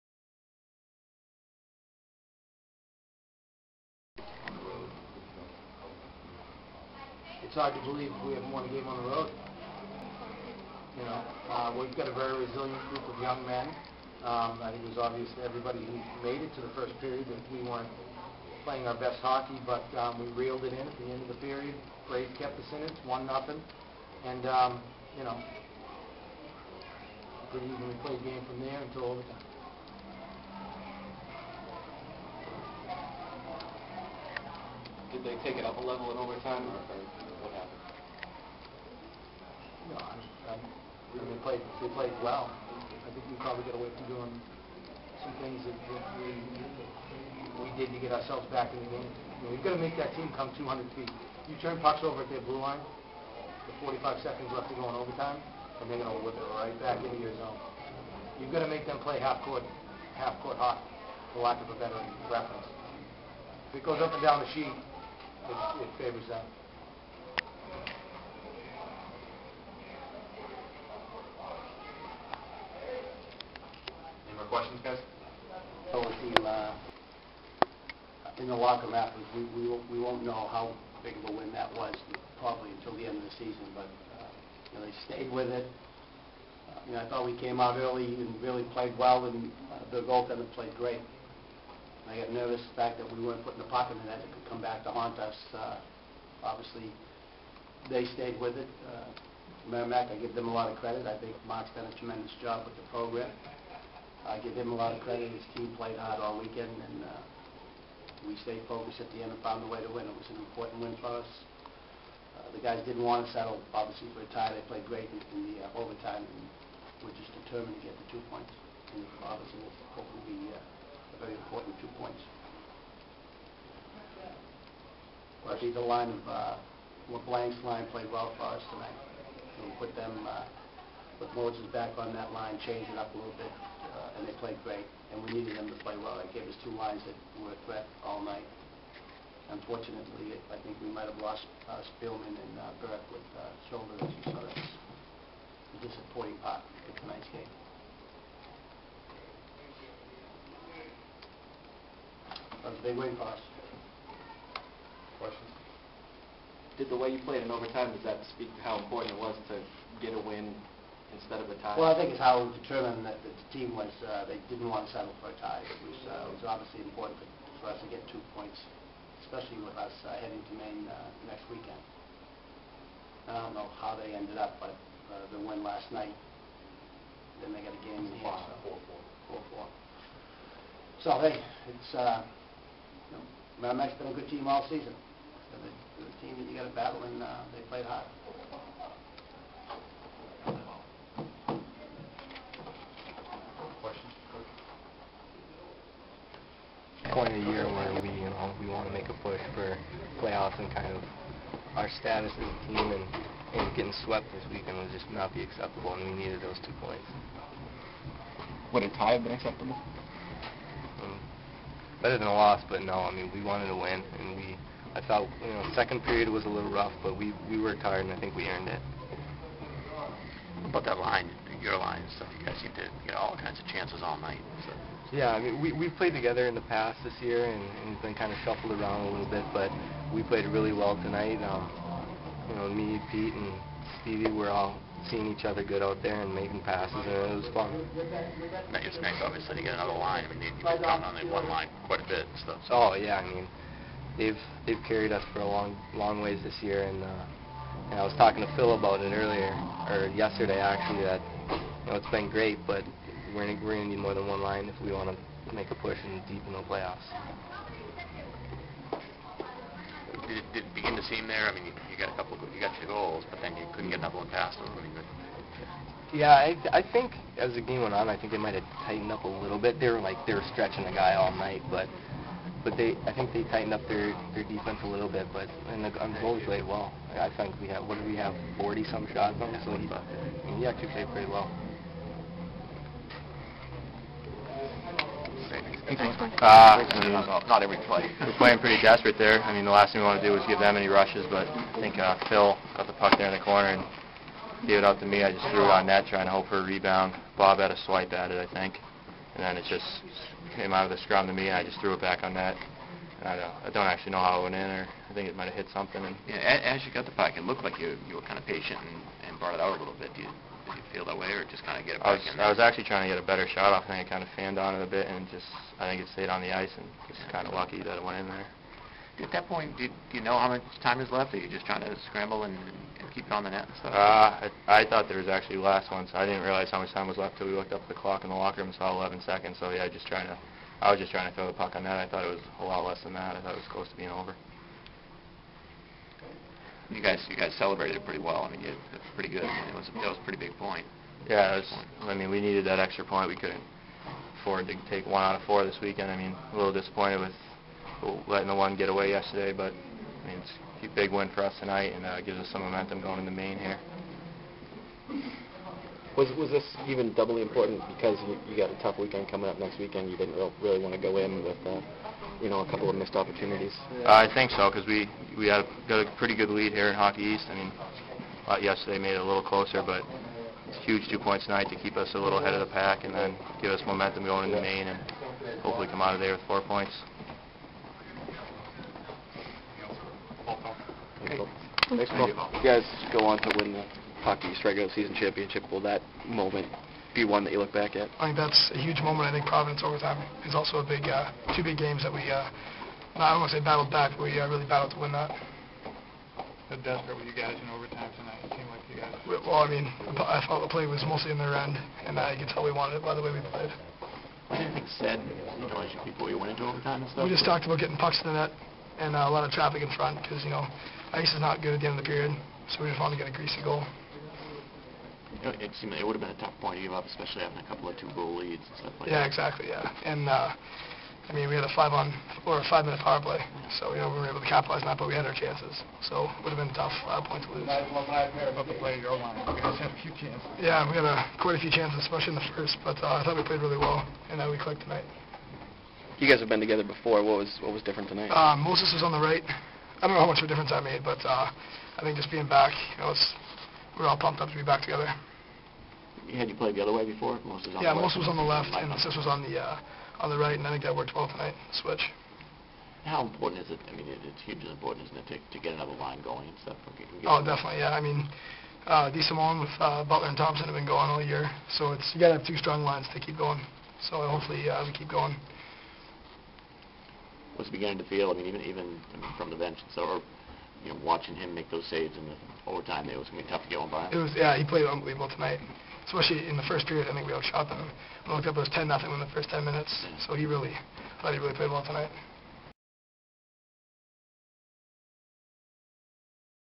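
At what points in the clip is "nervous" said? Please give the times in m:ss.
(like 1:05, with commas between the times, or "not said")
1:32.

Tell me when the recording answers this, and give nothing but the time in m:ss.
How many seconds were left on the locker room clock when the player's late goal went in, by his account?
5:28.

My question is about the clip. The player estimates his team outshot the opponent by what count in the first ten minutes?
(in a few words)
10-0.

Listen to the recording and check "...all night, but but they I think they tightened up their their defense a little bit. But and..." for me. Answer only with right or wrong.
right.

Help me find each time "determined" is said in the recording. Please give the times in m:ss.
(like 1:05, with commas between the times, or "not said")
1:57, 2:42.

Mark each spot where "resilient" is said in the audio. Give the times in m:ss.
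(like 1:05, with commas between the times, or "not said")
0:12.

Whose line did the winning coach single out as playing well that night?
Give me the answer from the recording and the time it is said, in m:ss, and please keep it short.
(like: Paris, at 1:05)
LeBlanc, at 2:07.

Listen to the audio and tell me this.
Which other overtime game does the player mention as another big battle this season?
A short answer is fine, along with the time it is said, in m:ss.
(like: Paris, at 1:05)
Providence, at 6:29.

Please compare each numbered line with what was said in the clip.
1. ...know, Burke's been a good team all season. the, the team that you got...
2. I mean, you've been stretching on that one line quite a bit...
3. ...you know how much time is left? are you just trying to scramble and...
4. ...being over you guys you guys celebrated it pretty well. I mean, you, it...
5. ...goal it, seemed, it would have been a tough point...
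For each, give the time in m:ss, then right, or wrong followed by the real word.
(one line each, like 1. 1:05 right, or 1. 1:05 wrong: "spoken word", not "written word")
1. 3:03 wrong: "Merrimack", not "Burke"
2. 4:00 wrong: "counting", not "stretching"
3. 5:20 right
4. 5:33 right
5. 6:53 right.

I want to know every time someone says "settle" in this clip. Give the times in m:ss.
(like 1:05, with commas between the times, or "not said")
1:53, 2:44.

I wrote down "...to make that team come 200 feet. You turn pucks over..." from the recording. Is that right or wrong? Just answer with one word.
right.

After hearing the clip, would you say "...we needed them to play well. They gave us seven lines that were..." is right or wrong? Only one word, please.
wrong.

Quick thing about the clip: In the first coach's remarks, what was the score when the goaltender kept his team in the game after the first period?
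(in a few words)
1-0.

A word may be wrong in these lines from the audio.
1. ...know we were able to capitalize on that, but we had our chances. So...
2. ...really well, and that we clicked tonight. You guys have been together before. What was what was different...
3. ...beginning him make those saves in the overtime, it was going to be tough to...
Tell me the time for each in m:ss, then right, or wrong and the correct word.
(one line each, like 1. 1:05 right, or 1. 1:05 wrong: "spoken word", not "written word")
1. 7:04 right
2. 7:13 right
3. 7:51 wrong: "watching", not "beginning".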